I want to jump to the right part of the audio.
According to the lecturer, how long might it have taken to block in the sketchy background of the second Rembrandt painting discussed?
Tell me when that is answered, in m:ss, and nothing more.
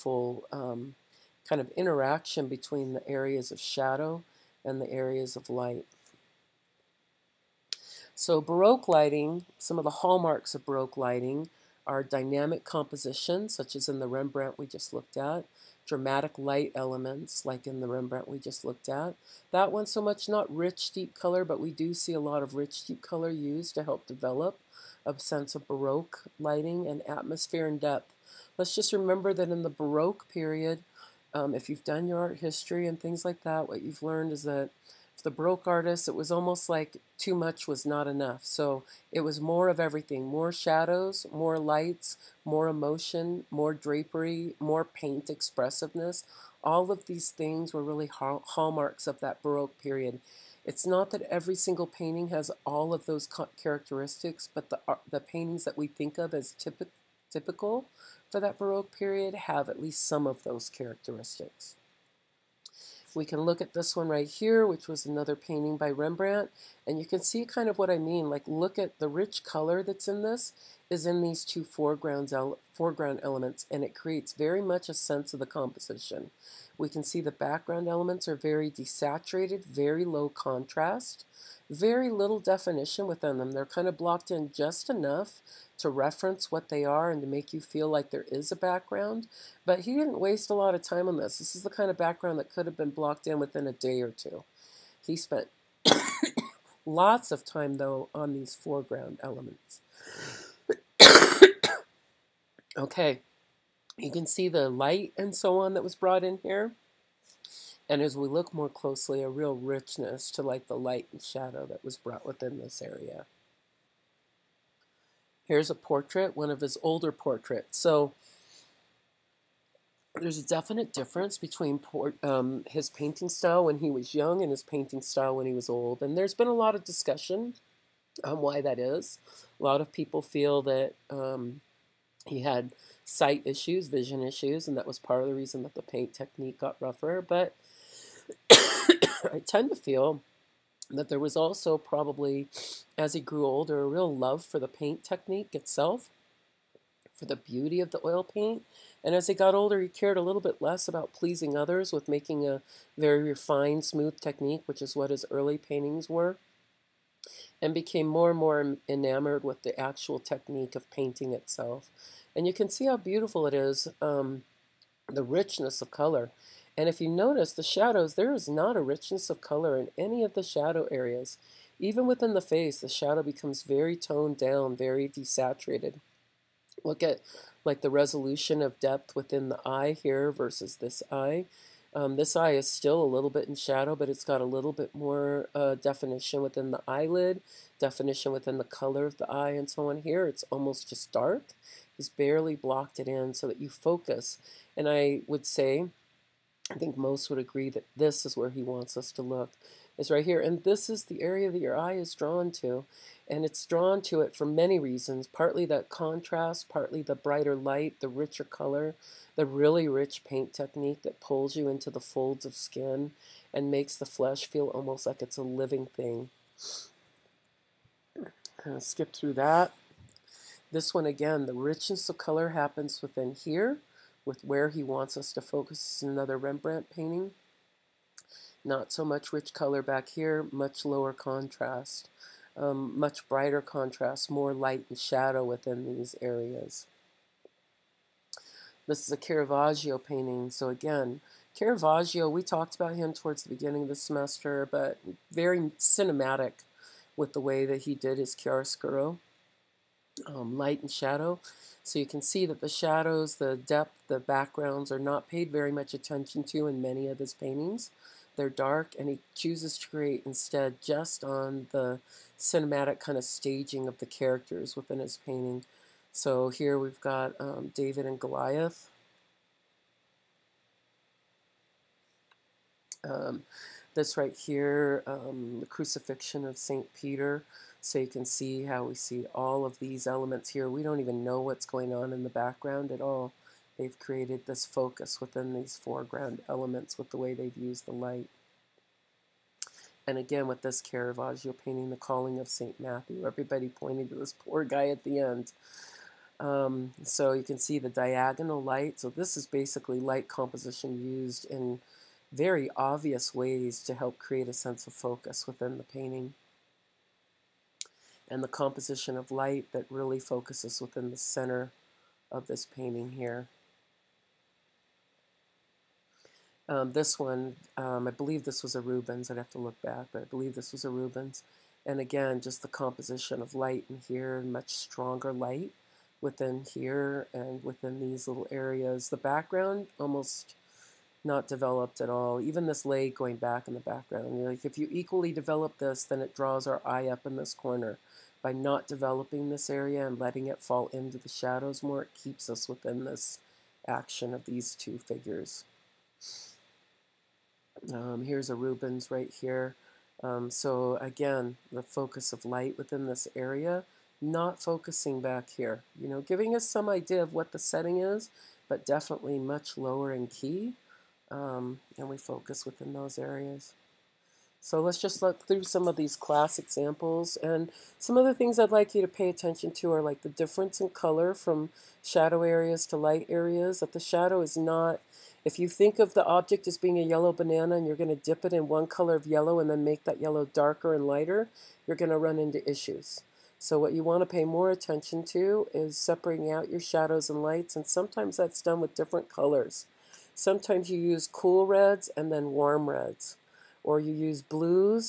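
1:33.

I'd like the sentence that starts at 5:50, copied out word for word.
Um, so again, the focus of light within this area, not focusing back here.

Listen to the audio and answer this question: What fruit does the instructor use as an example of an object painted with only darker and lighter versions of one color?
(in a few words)
Banana.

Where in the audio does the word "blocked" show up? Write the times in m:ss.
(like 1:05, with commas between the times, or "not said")
1:23, 1:32, 3:12.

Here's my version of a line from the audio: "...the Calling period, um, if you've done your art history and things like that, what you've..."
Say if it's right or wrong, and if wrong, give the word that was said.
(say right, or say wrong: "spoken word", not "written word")
wrong: "Baroque", not "Calling".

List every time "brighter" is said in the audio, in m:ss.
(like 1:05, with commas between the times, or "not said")
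3:27, 3:53.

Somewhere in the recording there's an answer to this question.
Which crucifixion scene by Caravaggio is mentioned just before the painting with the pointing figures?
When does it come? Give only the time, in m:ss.
4:35.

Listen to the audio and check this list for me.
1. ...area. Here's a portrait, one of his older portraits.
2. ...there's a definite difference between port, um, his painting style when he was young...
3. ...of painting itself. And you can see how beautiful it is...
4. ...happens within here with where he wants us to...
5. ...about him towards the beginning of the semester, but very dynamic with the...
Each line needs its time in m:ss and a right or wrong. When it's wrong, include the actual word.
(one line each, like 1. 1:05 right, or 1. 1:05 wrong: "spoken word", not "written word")
1. 1:52 right
2. 2:00 right
3. 2:40 right
4. 3:42 right
5. 4:02 wrong: "cinematic", not "dynamic".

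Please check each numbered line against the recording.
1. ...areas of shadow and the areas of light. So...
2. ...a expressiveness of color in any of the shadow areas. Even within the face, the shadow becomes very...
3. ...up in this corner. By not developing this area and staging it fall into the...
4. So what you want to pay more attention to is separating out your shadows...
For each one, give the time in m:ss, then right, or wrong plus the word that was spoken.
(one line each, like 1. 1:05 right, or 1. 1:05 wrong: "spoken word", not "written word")
1. 0:03 right
2. 2:48 wrong: "richness", not "expressiveness"
3. 5:37 wrong: "letting", not "staging"
4. 6:23 right.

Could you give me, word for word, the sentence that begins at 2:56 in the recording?
Look at like the resolution of depth within the eye here versus this eye.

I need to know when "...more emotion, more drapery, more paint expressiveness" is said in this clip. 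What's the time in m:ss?
0:42.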